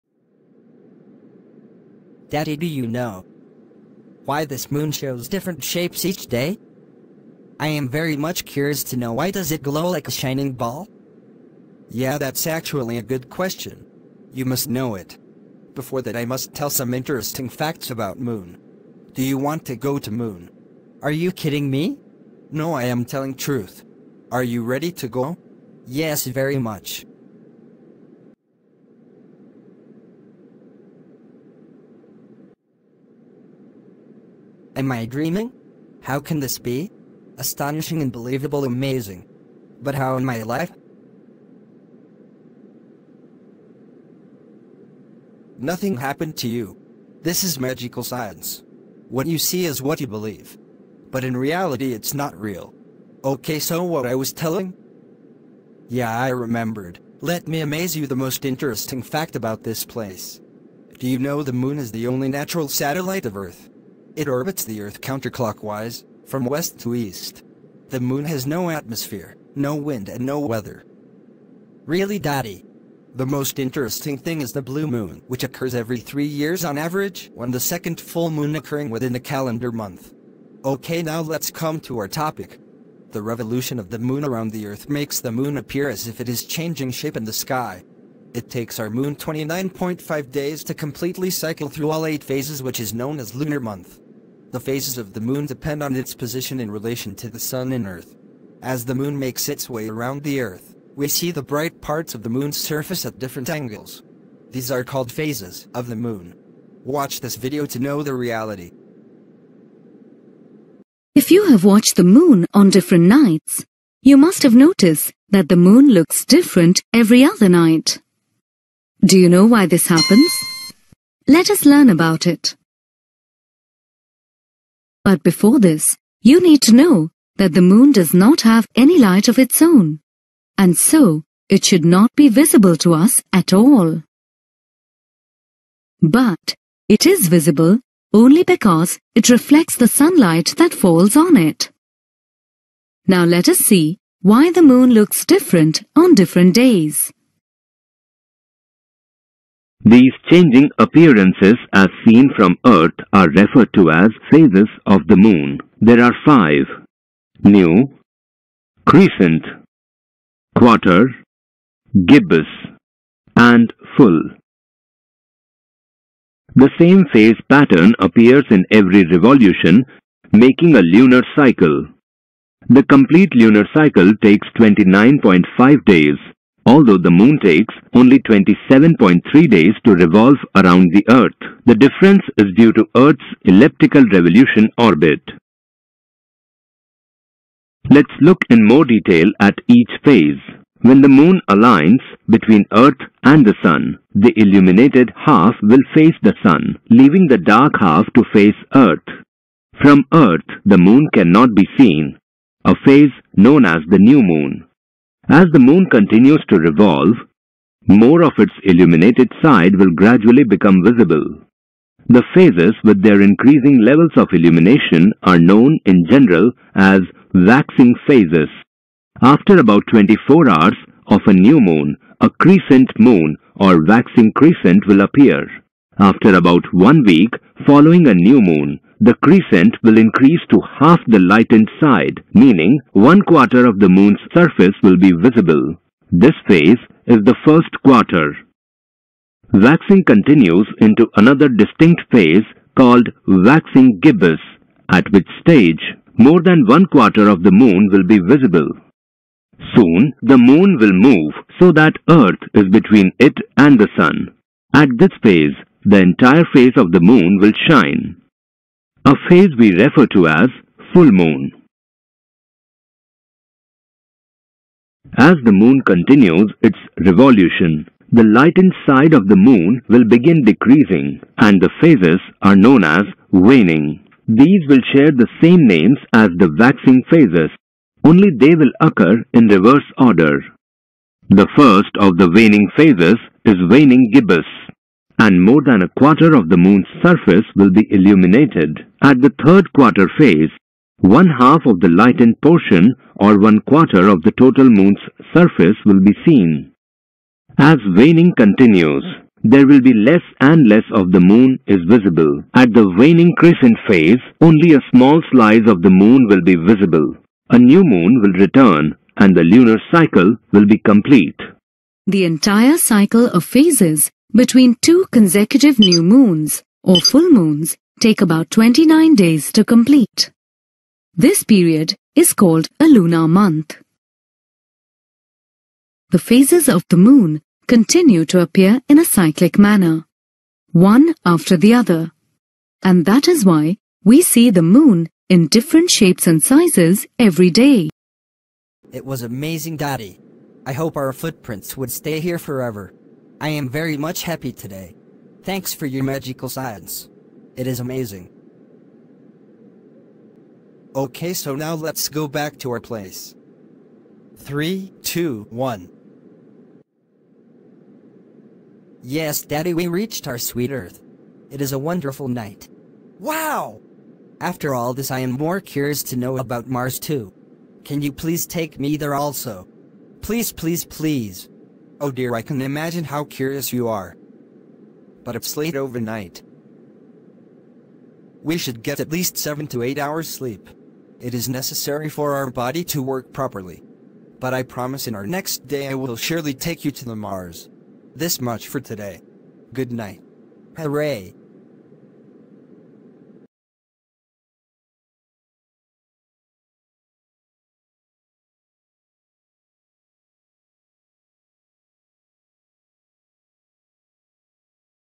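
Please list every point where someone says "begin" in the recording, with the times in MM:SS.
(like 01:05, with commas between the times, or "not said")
04:30.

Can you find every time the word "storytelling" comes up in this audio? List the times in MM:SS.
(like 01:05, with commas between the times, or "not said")
not said.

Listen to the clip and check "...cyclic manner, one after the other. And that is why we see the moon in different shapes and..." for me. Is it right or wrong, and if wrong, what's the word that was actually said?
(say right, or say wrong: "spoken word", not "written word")
right.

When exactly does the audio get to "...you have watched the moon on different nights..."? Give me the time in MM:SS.
01:51.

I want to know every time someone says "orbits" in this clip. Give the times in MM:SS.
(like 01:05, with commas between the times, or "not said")
01:04, 03:04.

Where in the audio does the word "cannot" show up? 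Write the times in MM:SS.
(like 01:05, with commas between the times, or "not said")
03:21.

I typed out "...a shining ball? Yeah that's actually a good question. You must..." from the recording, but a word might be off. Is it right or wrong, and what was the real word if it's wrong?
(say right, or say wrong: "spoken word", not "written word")
right.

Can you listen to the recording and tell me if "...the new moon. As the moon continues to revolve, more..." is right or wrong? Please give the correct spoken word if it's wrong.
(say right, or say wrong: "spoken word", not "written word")
right.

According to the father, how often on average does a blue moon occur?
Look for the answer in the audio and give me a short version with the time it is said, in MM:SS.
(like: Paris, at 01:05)
every 3 years, at 01:15.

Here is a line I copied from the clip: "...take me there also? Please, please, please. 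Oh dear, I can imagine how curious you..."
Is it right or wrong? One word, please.
right.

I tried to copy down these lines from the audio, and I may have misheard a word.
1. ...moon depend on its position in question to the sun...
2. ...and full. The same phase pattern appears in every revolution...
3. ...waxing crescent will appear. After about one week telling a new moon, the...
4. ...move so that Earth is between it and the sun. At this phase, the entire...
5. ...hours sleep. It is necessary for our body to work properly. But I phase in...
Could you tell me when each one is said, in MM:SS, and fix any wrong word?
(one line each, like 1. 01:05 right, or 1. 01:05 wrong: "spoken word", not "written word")
1. 01:35 wrong: "relation", not "question"
2. 02:43 right
3. 03:43 wrong: "following", not "telling"
4. 04:10 right
5. 06:19 wrong: "promise", not "phase".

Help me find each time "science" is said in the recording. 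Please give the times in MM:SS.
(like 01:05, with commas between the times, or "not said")
00:48, 05:46.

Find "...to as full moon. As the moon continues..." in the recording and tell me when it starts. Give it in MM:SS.
04:20.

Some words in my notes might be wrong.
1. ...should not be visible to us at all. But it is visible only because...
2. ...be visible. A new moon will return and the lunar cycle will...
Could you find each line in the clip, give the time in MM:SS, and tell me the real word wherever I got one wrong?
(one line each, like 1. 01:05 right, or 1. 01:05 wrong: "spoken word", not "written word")
1. 02:11 right
2. 05:06 right.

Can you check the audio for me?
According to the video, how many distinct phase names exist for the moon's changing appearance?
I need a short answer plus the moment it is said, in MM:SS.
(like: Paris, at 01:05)
5, at 02:36.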